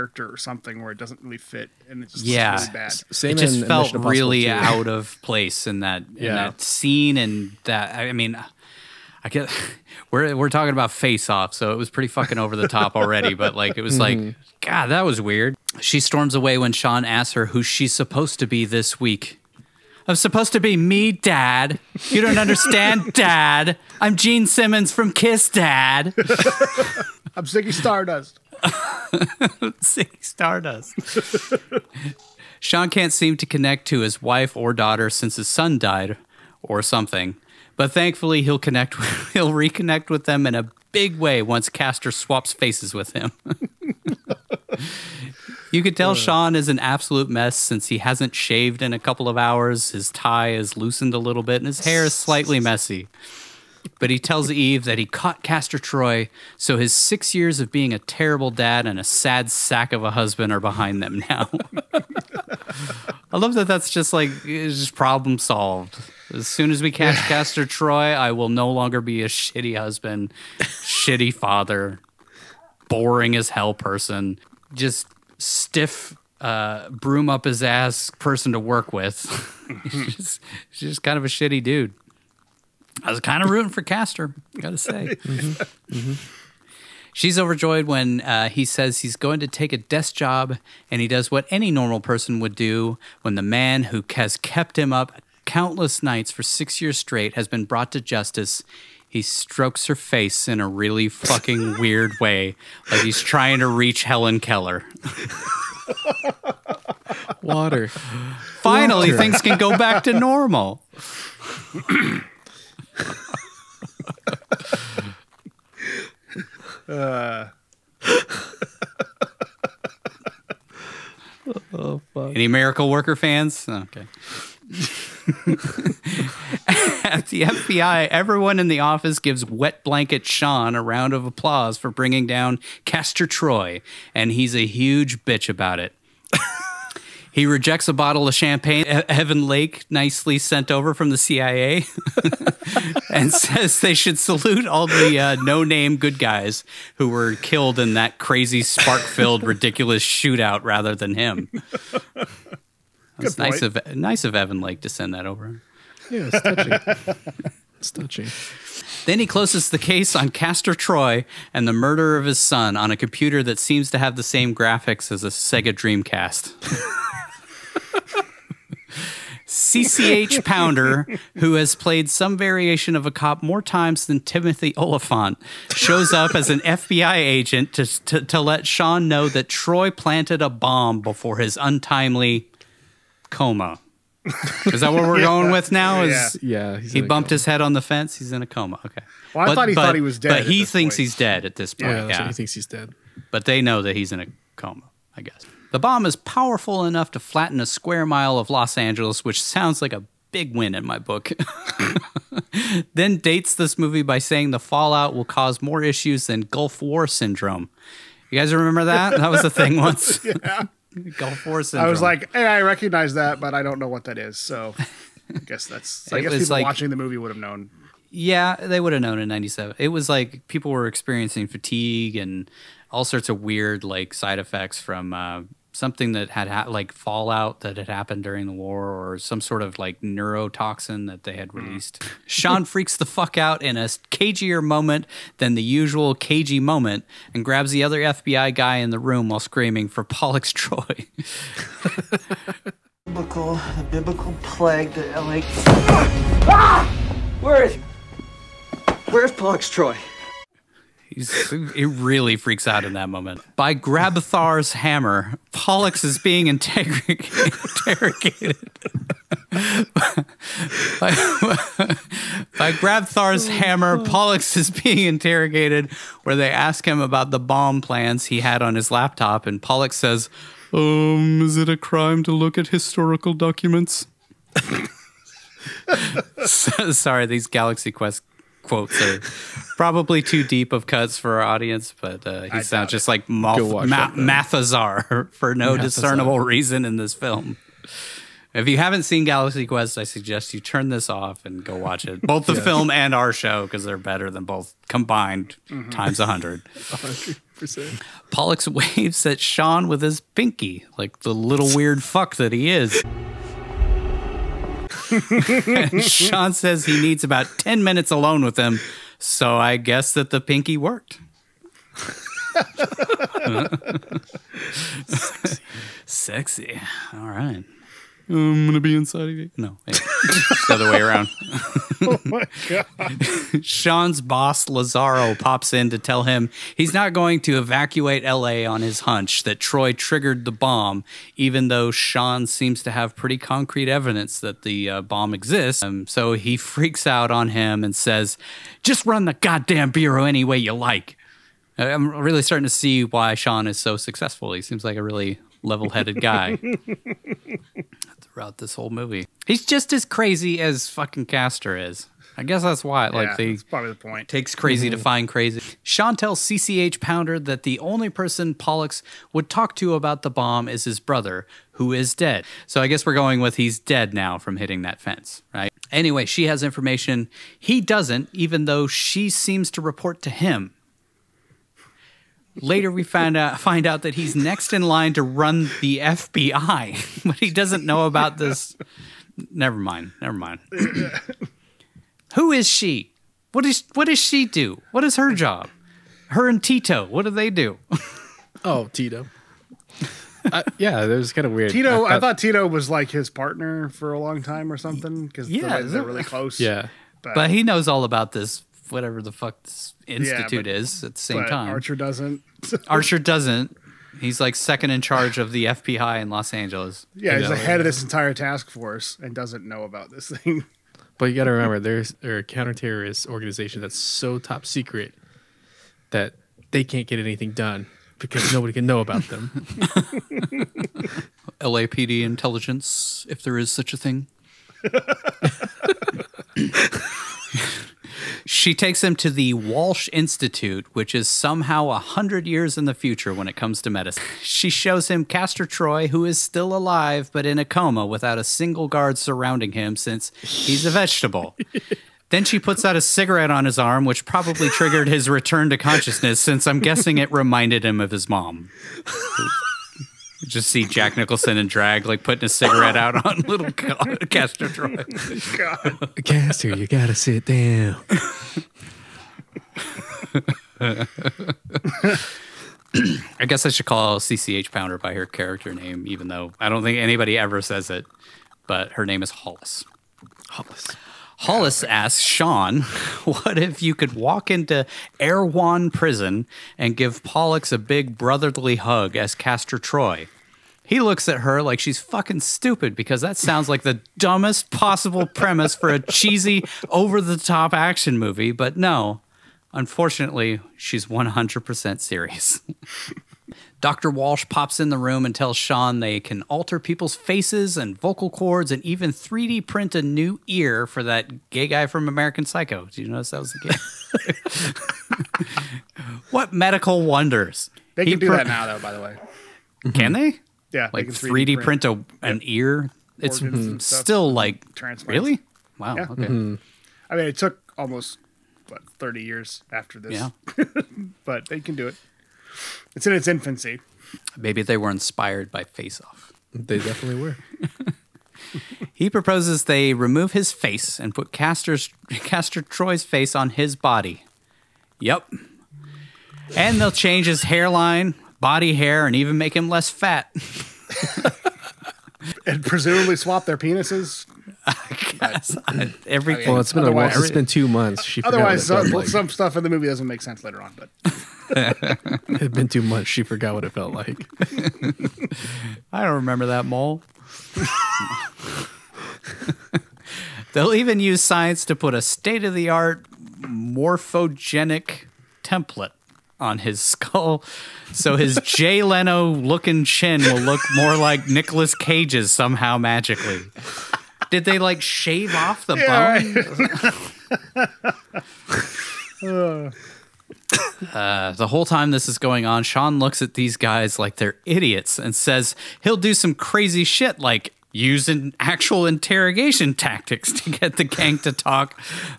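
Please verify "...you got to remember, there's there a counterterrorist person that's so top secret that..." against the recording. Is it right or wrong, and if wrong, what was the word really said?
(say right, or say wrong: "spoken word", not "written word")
wrong: "organization", not "person".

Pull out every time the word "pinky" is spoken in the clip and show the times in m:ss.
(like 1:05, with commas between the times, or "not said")
5:00, 5:10.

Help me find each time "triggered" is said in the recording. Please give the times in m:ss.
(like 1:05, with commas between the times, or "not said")
5:29, 7:24.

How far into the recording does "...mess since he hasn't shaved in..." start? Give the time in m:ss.
0:47.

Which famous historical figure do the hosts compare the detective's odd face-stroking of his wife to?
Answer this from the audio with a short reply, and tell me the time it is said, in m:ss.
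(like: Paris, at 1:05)
Helen Keller, at 1:44.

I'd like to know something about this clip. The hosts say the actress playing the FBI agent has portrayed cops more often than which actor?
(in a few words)
Timothy Olyphant.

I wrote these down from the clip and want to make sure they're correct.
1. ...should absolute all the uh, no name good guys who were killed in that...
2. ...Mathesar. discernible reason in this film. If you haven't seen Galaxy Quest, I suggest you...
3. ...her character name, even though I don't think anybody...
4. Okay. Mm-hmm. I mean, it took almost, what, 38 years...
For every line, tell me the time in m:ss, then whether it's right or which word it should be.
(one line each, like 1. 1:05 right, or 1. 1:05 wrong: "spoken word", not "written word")
1. 2:23 wrong: "salute", not "absolute"
2. 4:45 right
3. 7:45 right
4. 8:36 wrong: "30", not "38".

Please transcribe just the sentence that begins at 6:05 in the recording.
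Anyway, she has information he doesn't, even though she seems to report to him.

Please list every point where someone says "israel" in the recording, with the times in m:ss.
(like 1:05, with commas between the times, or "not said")
not said.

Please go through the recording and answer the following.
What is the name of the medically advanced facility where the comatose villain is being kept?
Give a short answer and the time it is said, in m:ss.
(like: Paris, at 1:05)
Walsh Institute, at 7:09.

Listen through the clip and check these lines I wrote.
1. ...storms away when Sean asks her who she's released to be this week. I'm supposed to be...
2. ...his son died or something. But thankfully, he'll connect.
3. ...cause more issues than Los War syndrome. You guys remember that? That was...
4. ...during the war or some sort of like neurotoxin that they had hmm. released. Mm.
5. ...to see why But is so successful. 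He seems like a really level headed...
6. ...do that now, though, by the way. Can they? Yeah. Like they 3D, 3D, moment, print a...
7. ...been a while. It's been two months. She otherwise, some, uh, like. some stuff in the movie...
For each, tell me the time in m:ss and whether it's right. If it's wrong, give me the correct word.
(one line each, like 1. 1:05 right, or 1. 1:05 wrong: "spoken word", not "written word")
1. 0:15 wrong: "supposed", not "released"
2. 0:35 right
3. 3:25 wrong: "Gulf", not "Los"
4. 3:48 right
5. 5:42 wrong: "Sean", not "But"
6. 8:28 wrong: "print", not "moment"
7. 9:06 right.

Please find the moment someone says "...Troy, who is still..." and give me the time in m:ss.
7:15.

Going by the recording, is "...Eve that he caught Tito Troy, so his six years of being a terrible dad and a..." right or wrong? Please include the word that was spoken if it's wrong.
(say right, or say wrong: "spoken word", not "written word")
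wrong: "Castor", not "Tito".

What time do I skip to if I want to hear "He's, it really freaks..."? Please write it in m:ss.
4:11.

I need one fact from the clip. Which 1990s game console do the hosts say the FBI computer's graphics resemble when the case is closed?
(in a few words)
Sega Dreamcast.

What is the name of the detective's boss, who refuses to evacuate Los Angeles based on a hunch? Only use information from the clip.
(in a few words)
Lazarro.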